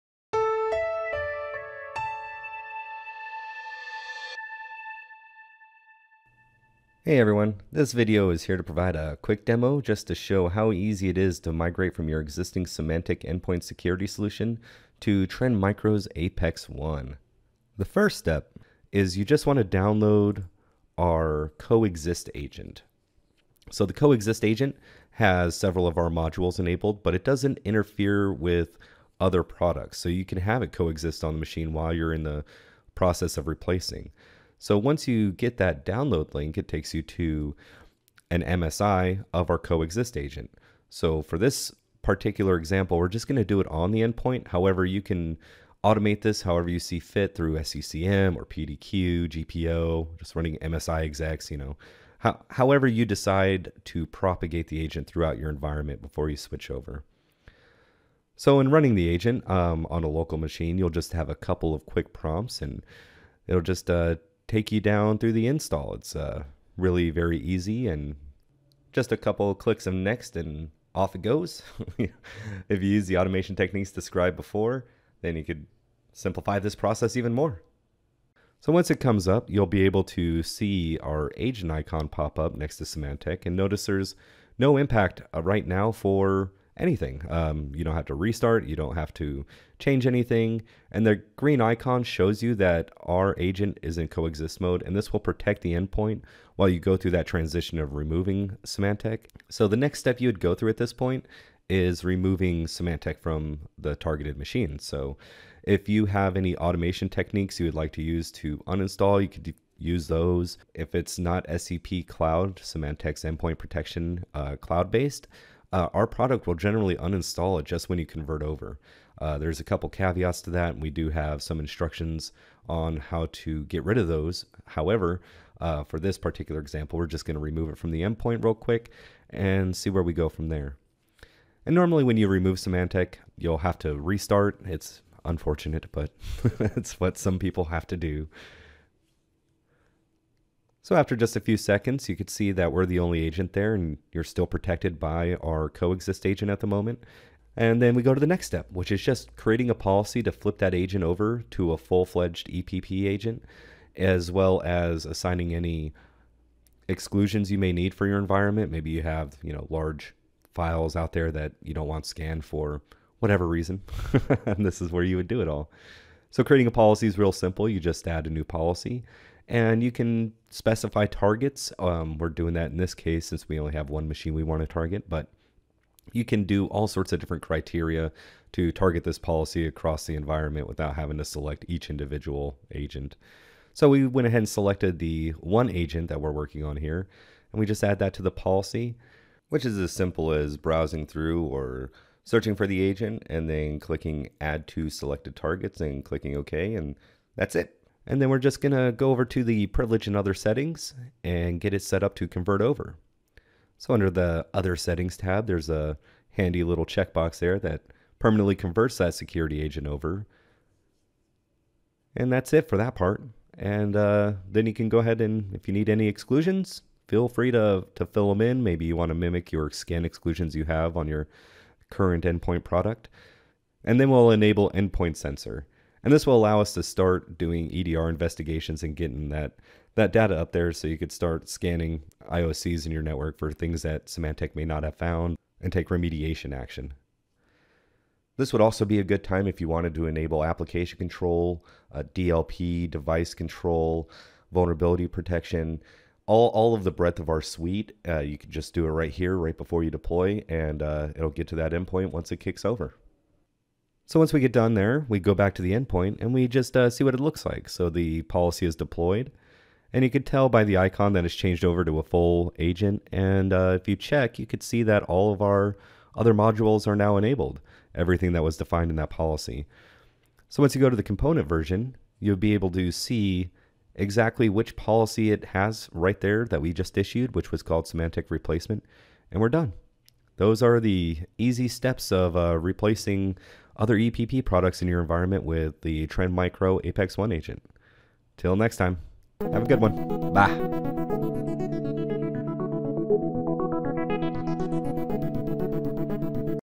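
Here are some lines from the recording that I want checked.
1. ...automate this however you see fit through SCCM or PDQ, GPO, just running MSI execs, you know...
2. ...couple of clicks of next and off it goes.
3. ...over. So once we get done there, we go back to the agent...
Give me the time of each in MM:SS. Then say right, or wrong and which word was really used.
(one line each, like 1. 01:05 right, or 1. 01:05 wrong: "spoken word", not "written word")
1. 00:45 right
2. 01:09 right
3. 04:12 wrong: "endpoint", not "agent".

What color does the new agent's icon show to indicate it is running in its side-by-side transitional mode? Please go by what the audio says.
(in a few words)
green.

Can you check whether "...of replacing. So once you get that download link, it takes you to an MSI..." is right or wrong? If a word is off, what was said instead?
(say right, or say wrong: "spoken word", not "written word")
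right.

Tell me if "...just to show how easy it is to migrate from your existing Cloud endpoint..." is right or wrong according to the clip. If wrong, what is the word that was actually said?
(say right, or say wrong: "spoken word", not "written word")
wrong: "Symantec", not "Cloud".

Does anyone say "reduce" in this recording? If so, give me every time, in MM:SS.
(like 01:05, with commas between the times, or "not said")
not said.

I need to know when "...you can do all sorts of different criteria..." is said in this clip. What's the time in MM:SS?
02:56.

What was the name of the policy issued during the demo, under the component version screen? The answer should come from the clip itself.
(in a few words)
Symantec replacement.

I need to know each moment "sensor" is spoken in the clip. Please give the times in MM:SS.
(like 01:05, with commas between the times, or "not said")
03:45.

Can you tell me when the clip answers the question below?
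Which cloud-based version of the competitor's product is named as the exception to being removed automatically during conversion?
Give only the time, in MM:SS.
01:51.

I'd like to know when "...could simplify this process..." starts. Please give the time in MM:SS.
01:15.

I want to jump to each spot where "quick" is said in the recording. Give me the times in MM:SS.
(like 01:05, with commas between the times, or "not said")
00:09, 01:01, 02:08.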